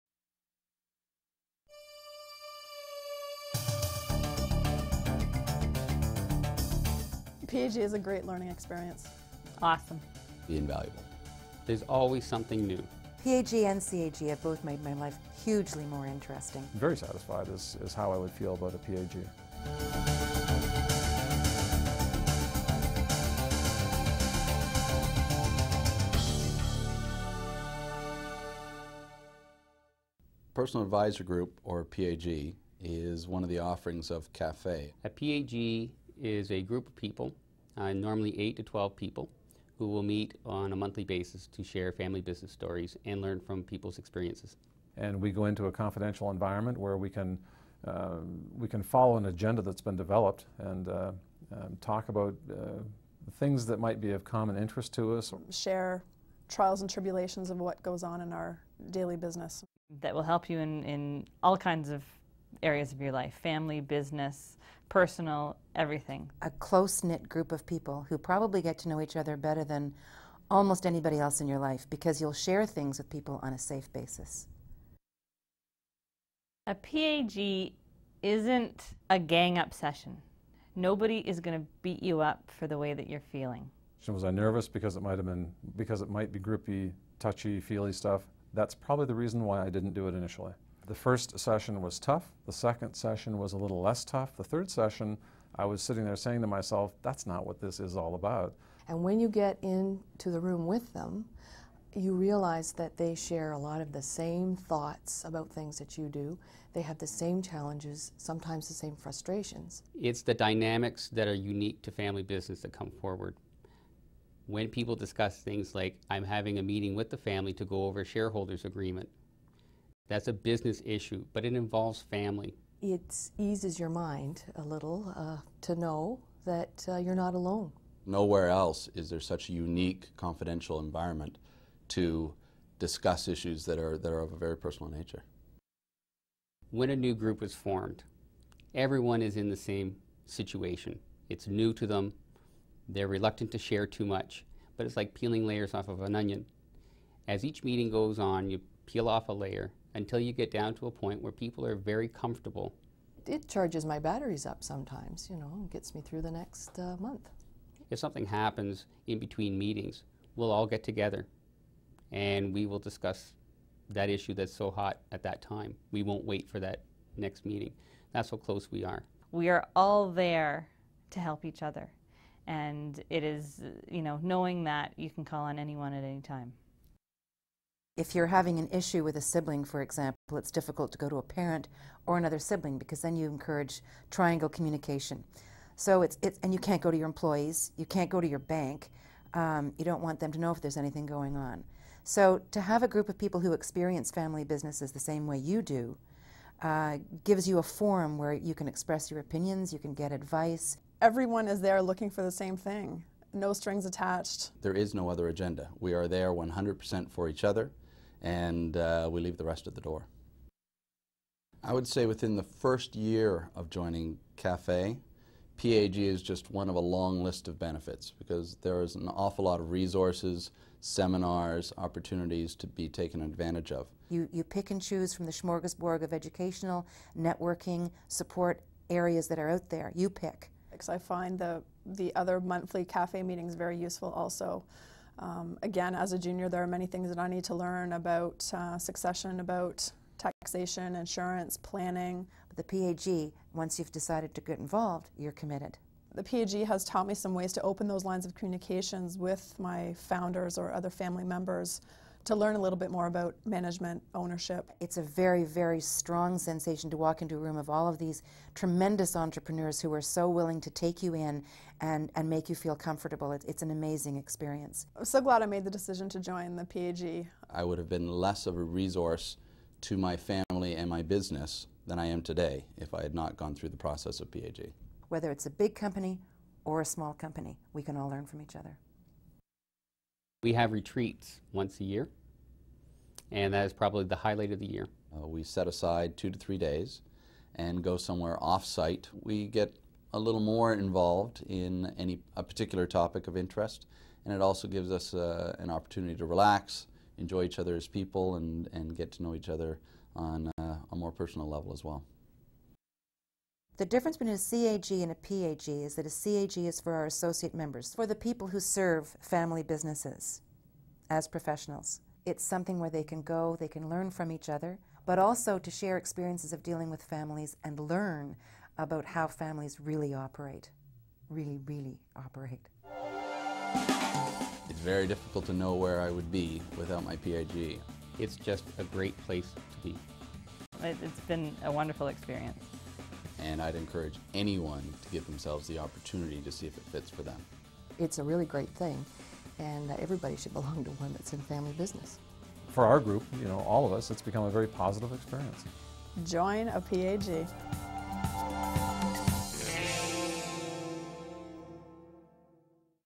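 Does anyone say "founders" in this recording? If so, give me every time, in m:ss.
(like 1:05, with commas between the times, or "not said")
4:09.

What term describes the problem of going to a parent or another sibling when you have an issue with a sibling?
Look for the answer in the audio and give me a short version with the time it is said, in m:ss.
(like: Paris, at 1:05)
Triangle communication, at 3:04.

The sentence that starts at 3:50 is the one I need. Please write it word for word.
Because I find the, the other monthly CAFE meetings very useful also.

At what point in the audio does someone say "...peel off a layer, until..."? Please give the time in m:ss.
2:28.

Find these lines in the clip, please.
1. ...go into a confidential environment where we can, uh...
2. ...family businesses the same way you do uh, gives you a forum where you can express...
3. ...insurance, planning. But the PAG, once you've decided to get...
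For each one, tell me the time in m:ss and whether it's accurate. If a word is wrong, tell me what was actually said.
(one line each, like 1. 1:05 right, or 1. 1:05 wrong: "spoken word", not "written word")
1. 0:45 right
2. 3:14 right
3. 4:00 right.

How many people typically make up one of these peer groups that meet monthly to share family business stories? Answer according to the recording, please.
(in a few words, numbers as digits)
8 to 12.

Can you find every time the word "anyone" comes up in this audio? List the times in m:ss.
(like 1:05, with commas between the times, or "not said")
2:55, 5:34.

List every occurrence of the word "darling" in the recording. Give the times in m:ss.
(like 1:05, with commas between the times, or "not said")
not said.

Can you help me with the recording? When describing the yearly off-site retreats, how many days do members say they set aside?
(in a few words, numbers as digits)
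2 to 3 days.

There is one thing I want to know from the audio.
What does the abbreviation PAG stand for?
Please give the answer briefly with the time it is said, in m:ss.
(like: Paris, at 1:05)
Personal Advisor Group, at 0:30.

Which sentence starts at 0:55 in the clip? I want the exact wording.
Share trials and tribulations of what goes on in our daily business.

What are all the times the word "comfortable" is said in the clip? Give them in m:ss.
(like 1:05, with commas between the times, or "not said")
2:32, 4:22.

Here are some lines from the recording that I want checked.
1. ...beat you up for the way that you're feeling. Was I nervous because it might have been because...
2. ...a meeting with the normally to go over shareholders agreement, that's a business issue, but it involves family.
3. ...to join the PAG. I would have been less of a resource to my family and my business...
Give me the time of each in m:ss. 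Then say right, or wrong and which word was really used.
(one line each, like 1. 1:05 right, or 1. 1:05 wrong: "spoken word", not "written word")
1. 1:21 right
2. 1:56 wrong: "family", not "normally"
3. 4:26 right.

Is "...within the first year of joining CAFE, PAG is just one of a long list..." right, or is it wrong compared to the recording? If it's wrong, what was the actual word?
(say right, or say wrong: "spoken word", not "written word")
right.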